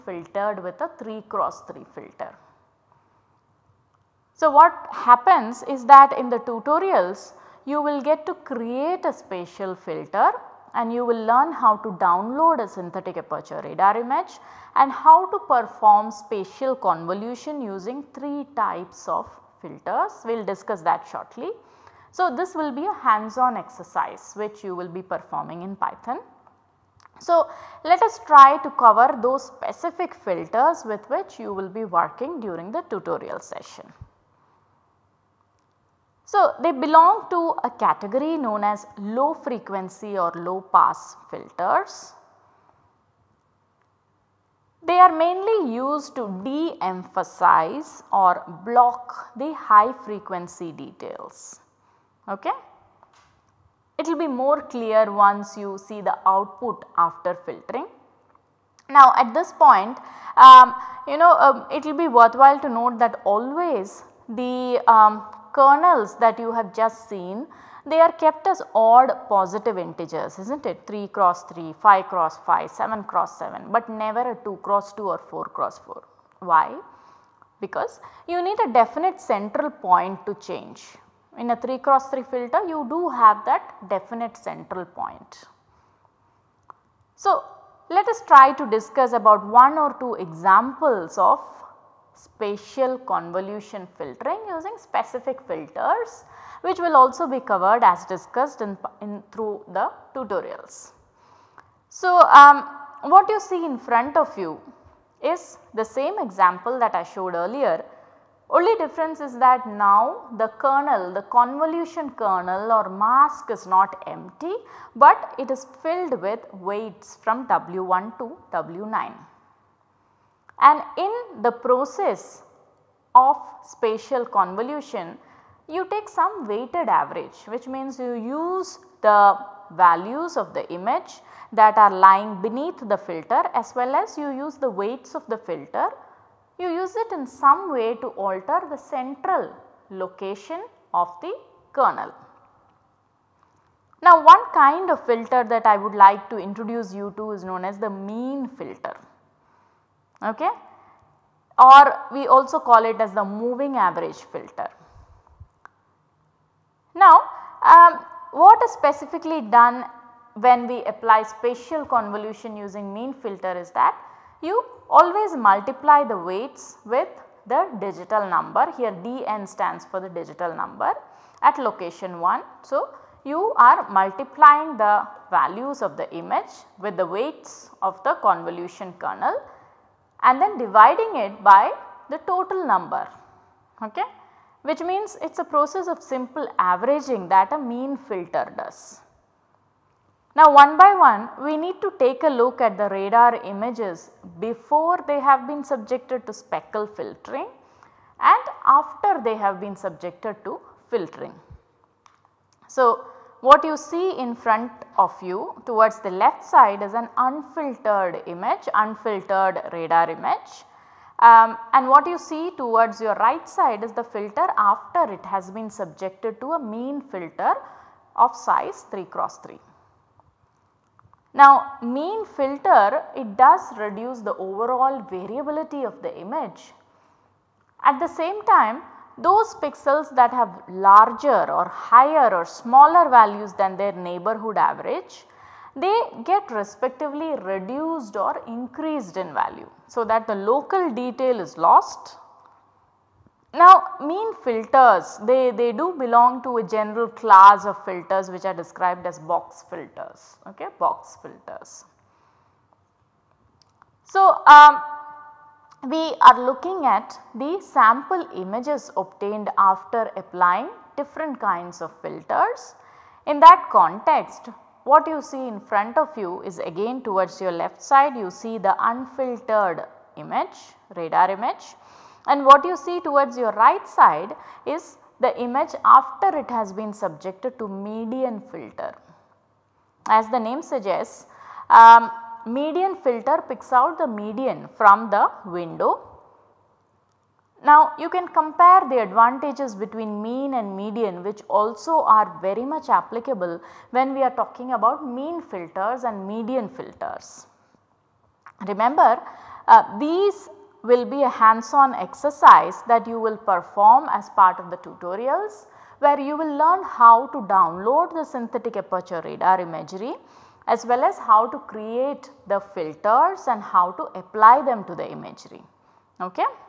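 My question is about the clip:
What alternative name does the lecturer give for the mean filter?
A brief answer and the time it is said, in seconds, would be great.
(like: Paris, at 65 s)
moving average filter, at 153 s.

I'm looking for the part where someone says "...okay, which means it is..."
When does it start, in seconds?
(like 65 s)
183 s.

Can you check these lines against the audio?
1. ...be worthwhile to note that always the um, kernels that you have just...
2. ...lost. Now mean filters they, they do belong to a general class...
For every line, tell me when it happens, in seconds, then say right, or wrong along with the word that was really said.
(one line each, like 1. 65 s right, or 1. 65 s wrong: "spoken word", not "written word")
1. 62 s right
2. 241 s right.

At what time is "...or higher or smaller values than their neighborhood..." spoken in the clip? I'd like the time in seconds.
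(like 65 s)
231 s.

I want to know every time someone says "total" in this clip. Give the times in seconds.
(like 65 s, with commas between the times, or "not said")
182 s.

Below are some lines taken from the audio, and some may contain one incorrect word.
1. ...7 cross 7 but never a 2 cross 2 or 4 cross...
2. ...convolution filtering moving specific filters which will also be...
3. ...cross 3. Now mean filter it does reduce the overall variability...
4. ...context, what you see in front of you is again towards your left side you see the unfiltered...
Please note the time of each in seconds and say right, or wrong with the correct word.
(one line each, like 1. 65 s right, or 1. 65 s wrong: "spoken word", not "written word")
1. 72 s right
2. 92 s wrong: "using", not "moving"
3. 219 s right
4. 263 s right.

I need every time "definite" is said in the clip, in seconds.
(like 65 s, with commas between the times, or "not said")
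78 s, 83 s.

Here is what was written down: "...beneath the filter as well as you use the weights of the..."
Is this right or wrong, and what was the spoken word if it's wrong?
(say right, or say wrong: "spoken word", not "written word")
right.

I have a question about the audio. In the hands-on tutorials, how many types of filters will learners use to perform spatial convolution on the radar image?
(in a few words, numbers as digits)
3.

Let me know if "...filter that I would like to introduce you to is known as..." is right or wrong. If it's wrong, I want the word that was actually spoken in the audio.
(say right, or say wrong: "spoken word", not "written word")
right.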